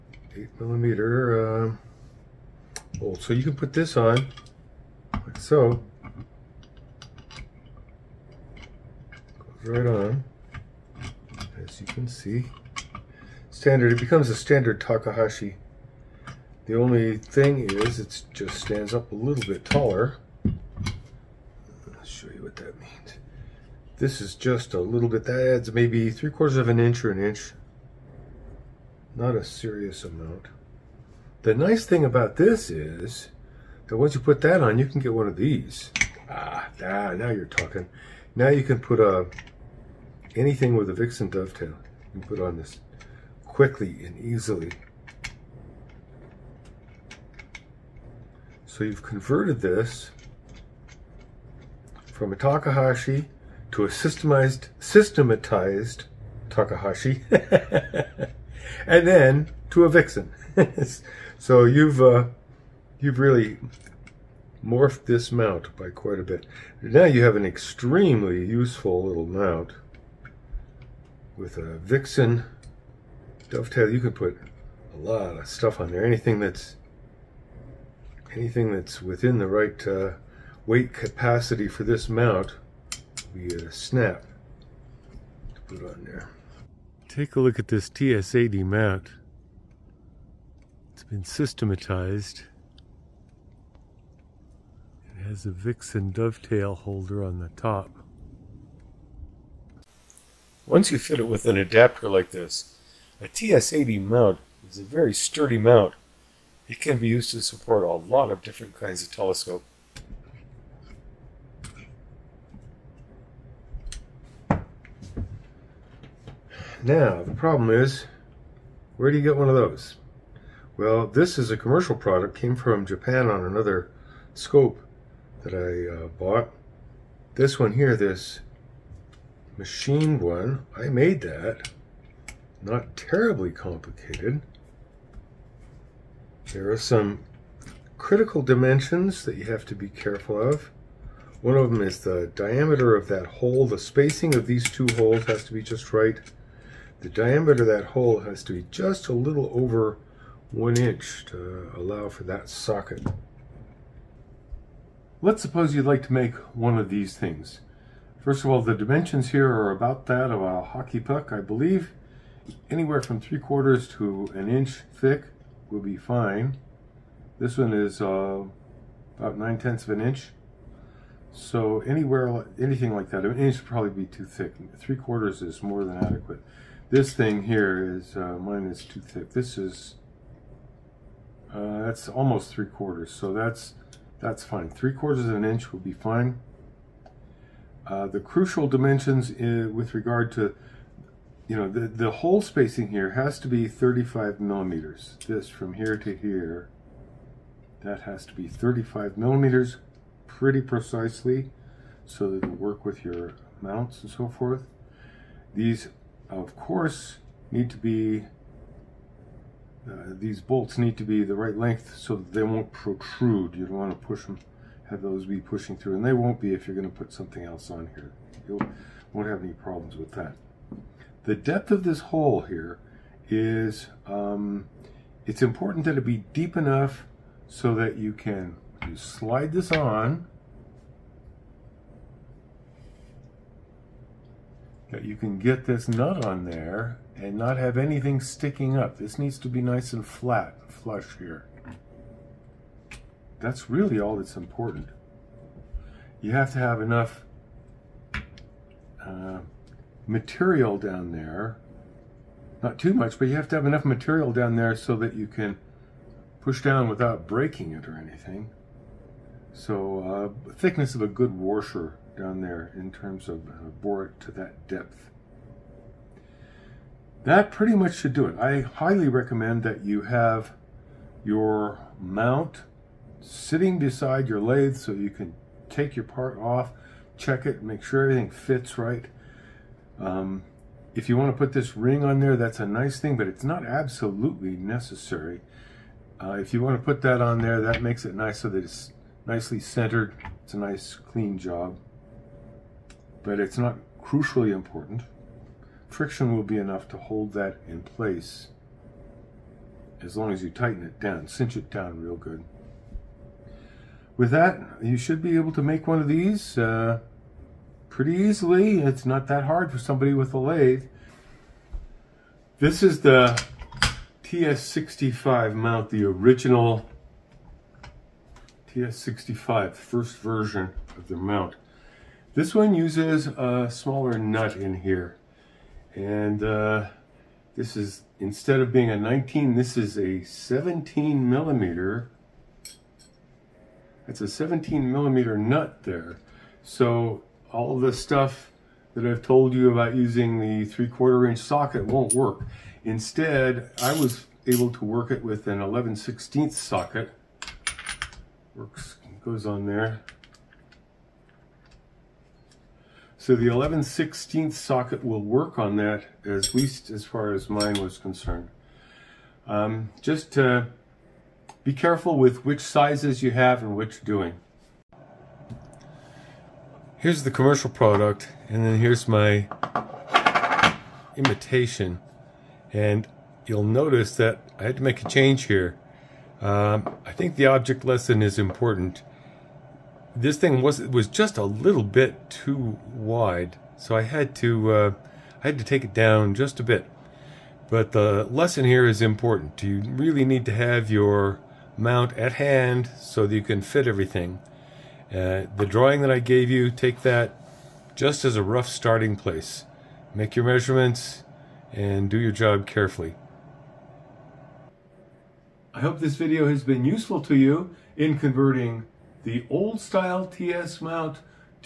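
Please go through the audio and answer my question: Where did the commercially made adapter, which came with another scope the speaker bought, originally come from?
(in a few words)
Japan.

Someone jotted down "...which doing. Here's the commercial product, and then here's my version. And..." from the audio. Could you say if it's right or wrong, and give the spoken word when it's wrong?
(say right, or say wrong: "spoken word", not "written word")
wrong: "imitation", not "version".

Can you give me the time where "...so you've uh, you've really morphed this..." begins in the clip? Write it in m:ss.
1:01.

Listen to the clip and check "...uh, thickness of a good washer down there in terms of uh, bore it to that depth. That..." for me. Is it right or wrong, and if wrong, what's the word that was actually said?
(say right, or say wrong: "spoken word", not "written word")
right.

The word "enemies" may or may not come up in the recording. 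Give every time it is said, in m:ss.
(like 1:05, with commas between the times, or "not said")
not said.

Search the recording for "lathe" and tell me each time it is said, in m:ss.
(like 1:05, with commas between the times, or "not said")
4:34, 5:10.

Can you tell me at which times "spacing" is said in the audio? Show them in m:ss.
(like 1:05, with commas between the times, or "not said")
2:23, 3:12.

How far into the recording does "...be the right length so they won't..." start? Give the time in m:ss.
3:31.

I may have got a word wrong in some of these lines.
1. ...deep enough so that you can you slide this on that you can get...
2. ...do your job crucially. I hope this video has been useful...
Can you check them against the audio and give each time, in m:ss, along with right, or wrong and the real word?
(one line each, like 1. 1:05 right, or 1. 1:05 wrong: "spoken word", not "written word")
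1. 3:46 right
2. 6:42 wrong: "carefully", not "crucially".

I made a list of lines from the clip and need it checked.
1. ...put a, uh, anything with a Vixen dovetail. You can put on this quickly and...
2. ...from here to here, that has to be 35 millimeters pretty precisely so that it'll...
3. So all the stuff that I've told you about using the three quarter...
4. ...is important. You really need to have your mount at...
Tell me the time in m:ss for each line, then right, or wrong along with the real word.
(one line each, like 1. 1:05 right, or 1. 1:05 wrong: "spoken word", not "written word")
1. 0:38 right
2. 3:15 right
3. 5:36 right
4. 6:28 right.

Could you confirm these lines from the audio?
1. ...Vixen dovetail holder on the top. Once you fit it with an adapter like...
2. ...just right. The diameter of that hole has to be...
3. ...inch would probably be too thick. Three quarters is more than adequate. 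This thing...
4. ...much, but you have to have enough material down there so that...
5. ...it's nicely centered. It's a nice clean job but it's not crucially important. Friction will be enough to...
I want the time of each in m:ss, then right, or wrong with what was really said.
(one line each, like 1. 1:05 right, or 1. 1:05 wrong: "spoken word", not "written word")
1. 1:35 right
2. 2:25 right
3. 2:53 right
4. 4:12 right
5. 4:48 right.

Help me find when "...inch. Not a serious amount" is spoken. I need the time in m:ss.
0:27.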